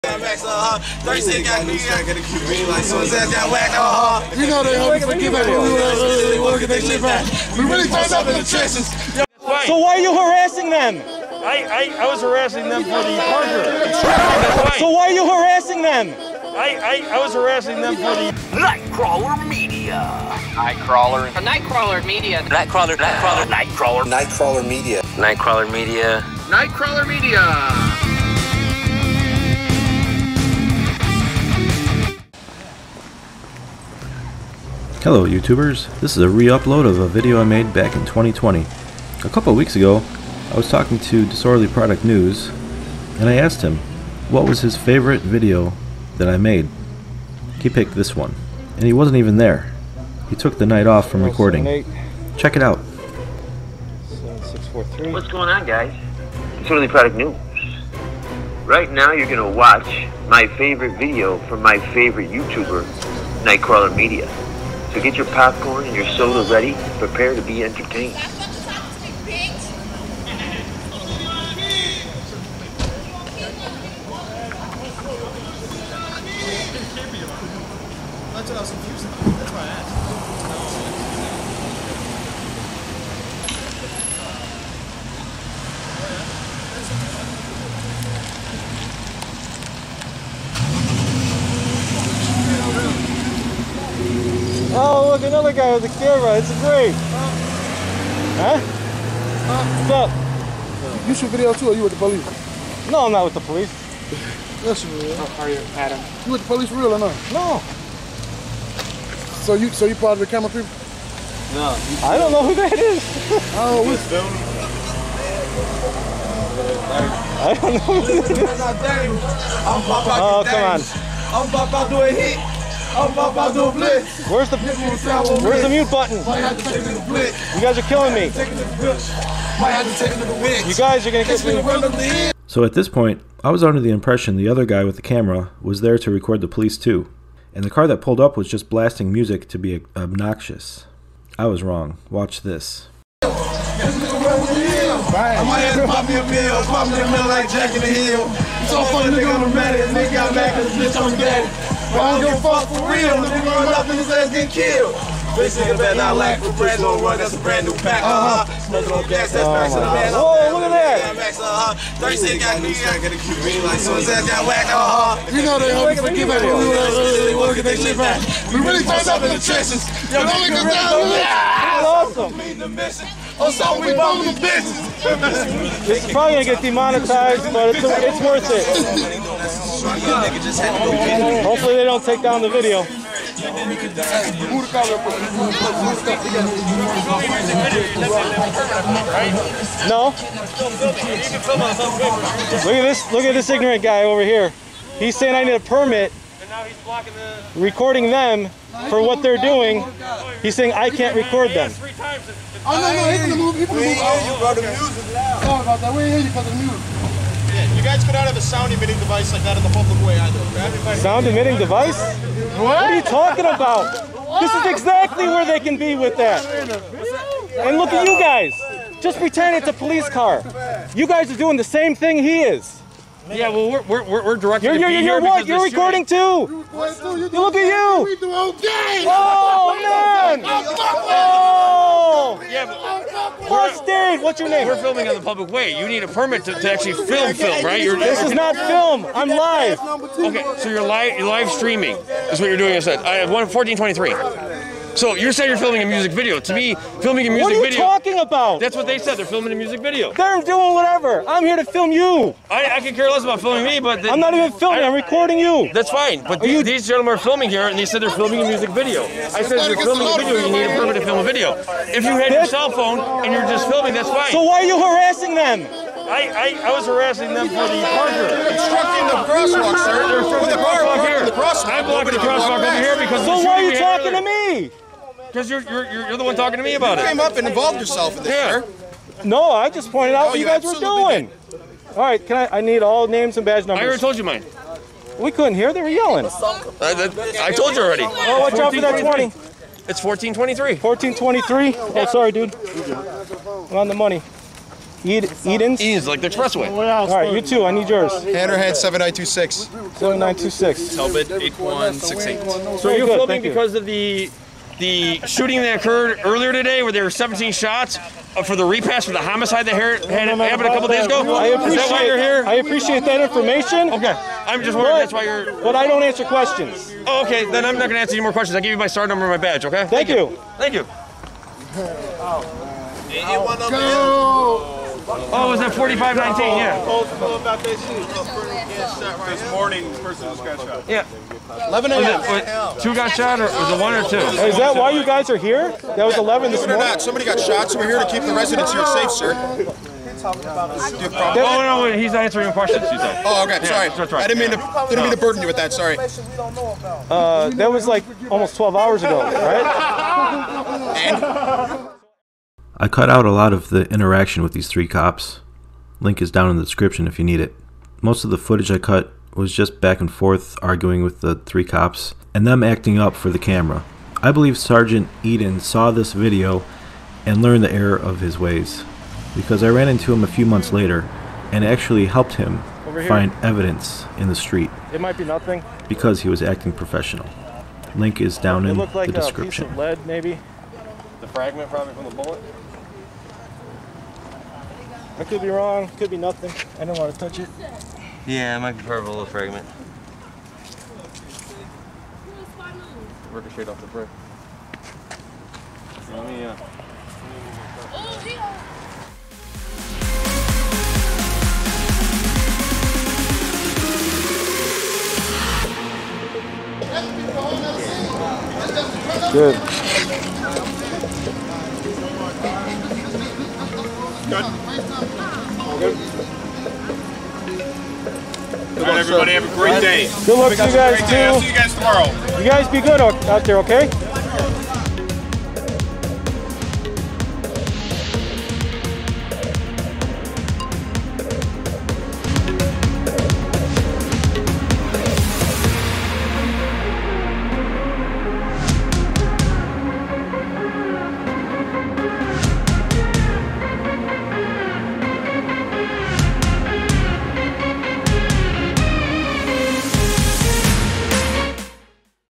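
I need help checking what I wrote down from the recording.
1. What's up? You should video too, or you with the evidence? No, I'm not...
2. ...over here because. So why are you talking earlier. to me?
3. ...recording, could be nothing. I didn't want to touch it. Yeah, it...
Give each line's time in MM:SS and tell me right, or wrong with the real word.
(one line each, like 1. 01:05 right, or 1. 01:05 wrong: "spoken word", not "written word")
1. 01:39 wrong: "police", not "evidence"
2. 04:32 right
3. 06:25 wrong: "wrong", not "recording".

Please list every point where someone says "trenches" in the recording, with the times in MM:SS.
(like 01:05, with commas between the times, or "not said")
00:08, 02:49.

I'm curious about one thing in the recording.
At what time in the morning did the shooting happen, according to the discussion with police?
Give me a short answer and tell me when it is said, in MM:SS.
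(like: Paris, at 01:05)
11 a.m., at 05:31.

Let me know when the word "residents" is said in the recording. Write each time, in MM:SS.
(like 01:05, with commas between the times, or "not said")
05:38.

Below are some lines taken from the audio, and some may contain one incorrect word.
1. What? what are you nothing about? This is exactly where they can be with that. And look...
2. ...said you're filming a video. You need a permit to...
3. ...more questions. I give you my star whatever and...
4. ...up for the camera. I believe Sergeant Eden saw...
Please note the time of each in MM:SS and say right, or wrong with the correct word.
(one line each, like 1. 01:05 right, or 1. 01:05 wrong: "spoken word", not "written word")
1. 03:31 wrong: "talking", not "nothing"
2. 04:19 right
3. 05:18 wrong: "number", not "whatever"
4. 06:02 right.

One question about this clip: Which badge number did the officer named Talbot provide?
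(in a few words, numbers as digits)
8168.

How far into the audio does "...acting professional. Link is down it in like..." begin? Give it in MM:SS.
06:16.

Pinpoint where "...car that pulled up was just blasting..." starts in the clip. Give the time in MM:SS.
02:17.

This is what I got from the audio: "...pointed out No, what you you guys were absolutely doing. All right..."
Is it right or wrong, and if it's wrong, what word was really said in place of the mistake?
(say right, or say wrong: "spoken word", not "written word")
right.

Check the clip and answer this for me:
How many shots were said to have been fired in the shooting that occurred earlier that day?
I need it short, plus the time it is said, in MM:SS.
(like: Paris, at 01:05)
17, at 05:07.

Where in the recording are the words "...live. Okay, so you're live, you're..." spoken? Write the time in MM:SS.
03:59.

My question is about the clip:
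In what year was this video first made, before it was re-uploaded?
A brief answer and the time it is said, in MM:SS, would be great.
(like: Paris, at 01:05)
2020, at 00:38.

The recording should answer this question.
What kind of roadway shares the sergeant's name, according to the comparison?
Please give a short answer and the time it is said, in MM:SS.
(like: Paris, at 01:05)
expressway, at 04:56.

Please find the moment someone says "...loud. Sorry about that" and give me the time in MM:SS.
03:25.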